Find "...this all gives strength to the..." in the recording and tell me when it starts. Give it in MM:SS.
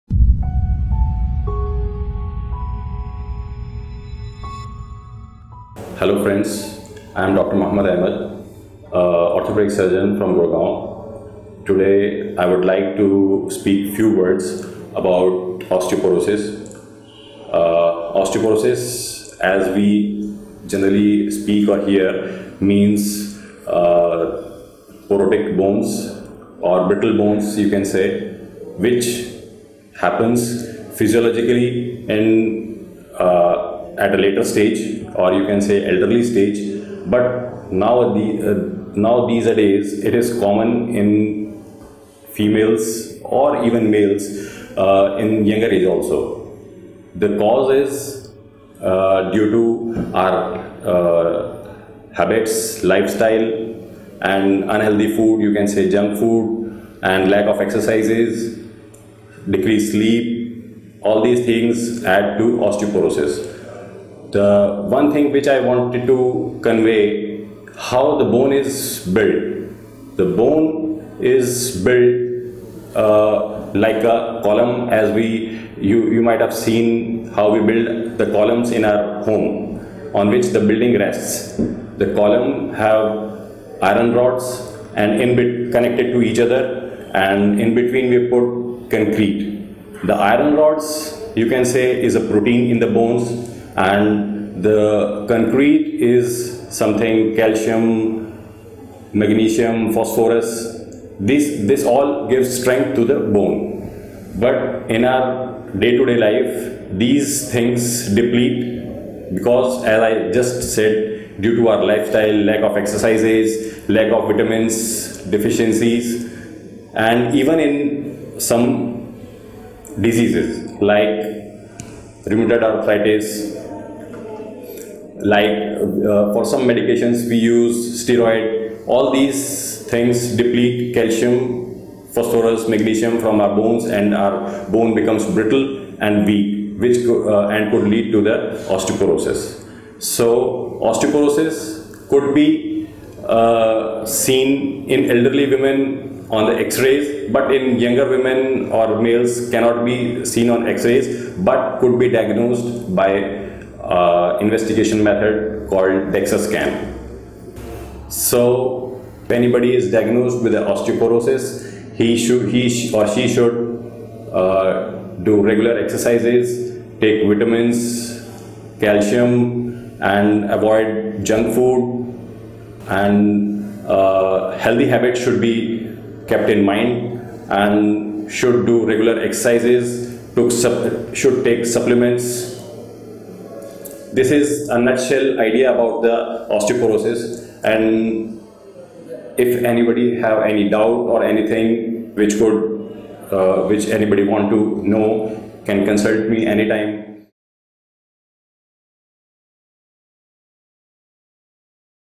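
01:41.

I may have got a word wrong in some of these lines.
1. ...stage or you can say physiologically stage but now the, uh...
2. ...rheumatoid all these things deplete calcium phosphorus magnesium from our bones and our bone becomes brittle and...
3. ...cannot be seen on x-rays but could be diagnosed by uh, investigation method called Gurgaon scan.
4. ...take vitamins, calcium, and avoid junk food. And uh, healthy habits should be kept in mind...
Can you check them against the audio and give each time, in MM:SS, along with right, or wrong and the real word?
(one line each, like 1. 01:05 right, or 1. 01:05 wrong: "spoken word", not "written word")
1. 00:34 wrong: "elderly", not "physiologically"
2. 02:08 wrong: "steroid", not "rheumatoid"
3. 02:29 wrong: "DEXA", not "Gurgaon"
4. 02:47 right.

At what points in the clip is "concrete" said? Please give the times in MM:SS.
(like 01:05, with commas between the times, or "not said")
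01:28, 01:35.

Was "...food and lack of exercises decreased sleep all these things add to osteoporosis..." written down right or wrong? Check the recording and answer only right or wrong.
right.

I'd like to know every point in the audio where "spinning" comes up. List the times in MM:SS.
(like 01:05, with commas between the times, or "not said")
not said.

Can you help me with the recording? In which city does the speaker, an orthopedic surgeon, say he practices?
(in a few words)
Gurgaon.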